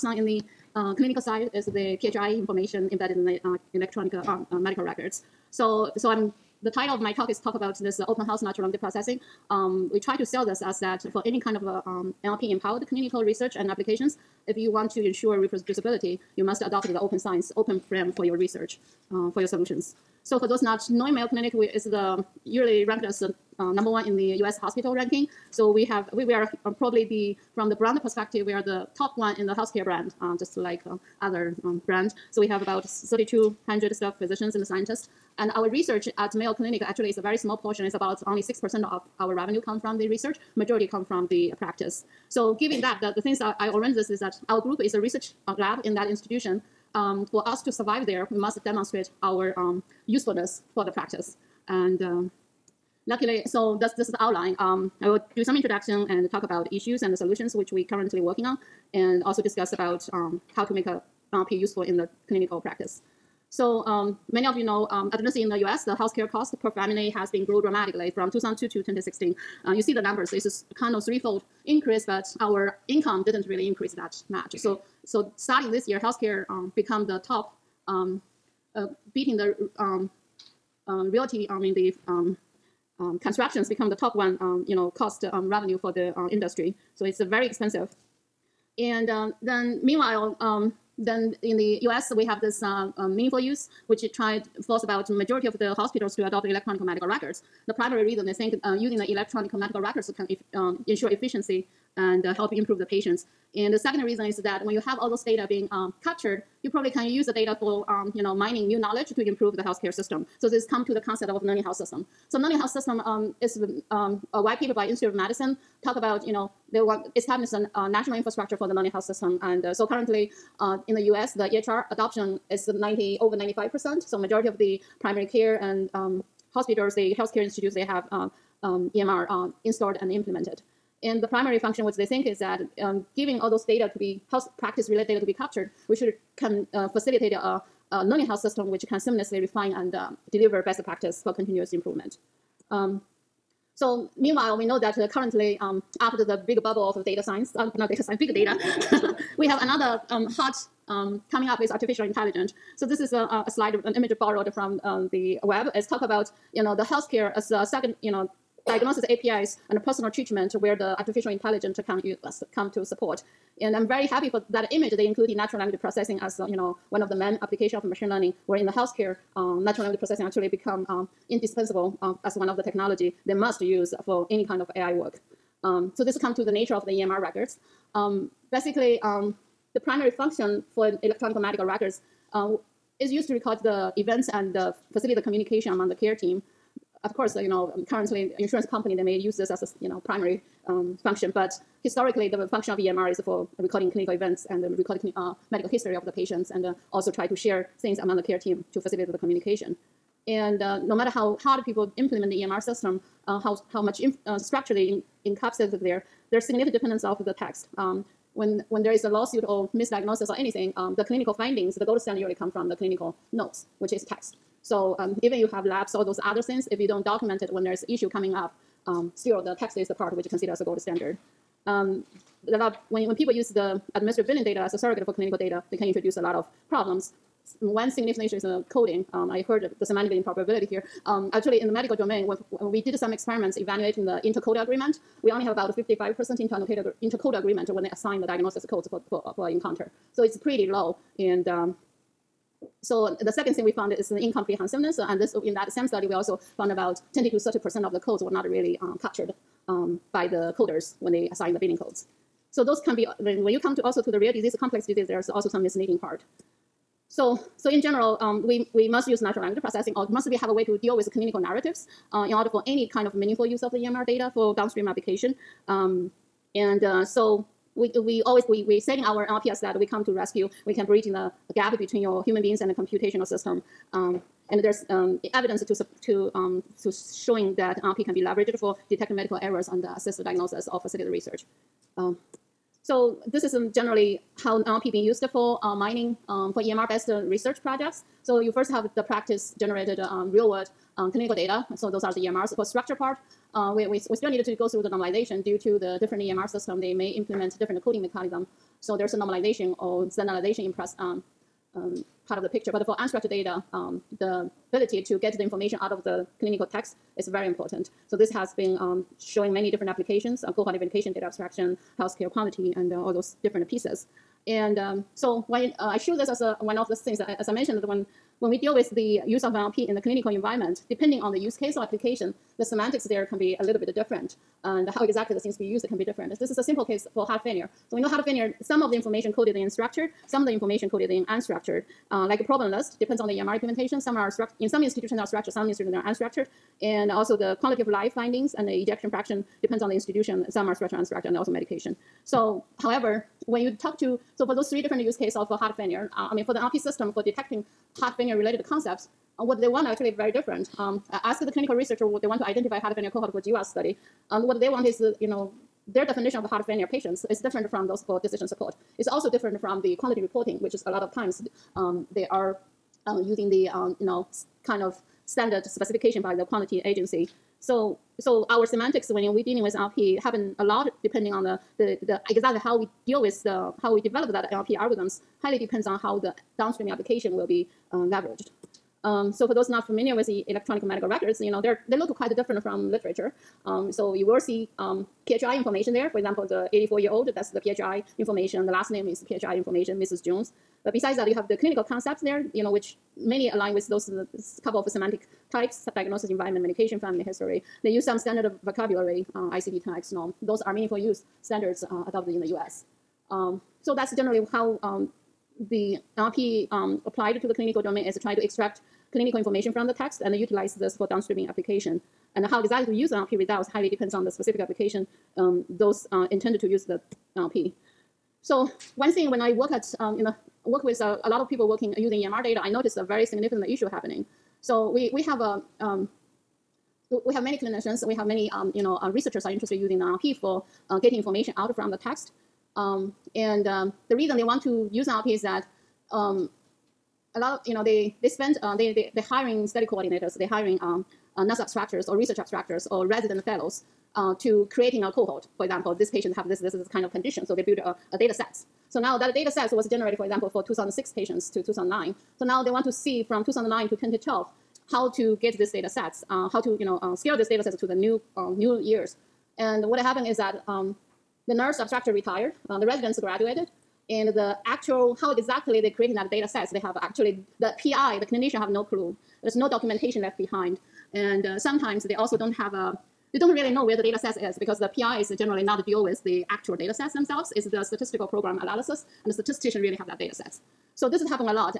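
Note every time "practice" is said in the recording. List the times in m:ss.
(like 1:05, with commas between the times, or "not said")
0:41, 0:50, 1:02, 2:14, 2:20, 4:49.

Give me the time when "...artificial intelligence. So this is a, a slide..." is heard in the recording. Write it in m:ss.
2:31.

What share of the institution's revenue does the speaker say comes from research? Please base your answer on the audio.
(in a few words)
6%.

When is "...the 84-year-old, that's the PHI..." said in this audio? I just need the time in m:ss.
6:26.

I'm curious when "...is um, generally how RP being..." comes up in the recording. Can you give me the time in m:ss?
4:43.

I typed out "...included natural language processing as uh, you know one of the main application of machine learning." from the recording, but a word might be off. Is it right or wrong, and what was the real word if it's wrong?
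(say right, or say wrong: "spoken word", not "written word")
right.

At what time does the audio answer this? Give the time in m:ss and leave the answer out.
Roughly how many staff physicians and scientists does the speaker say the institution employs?
0:32.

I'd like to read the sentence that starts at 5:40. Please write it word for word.
Some are structured, unstructured, and also medication.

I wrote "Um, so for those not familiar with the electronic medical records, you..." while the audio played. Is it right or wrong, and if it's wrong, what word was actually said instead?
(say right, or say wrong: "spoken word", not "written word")
right.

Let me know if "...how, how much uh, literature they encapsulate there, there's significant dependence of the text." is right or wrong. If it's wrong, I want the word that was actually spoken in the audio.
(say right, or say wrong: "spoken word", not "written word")
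wrong: "structure", not "literature".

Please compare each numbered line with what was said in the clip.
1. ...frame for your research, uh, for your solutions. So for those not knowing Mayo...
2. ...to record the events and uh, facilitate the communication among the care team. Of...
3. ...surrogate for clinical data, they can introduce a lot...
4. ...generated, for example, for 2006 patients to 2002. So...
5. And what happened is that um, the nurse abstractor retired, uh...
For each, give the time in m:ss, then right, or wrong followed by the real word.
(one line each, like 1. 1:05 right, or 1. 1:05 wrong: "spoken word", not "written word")
1. 0:17 right
2. 3:03 right
3. 3:44 right
4. 7:29 wrong: "2009", not "2002"
5. 7:39 right.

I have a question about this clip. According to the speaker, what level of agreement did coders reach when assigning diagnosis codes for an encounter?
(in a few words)
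55%.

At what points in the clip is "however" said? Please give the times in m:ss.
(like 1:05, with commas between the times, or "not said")
5:42.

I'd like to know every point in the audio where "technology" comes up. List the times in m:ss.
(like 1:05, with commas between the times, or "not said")
2:52.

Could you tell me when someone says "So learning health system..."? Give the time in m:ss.
1:52.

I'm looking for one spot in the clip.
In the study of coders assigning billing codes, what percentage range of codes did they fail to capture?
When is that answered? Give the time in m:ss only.
4:07.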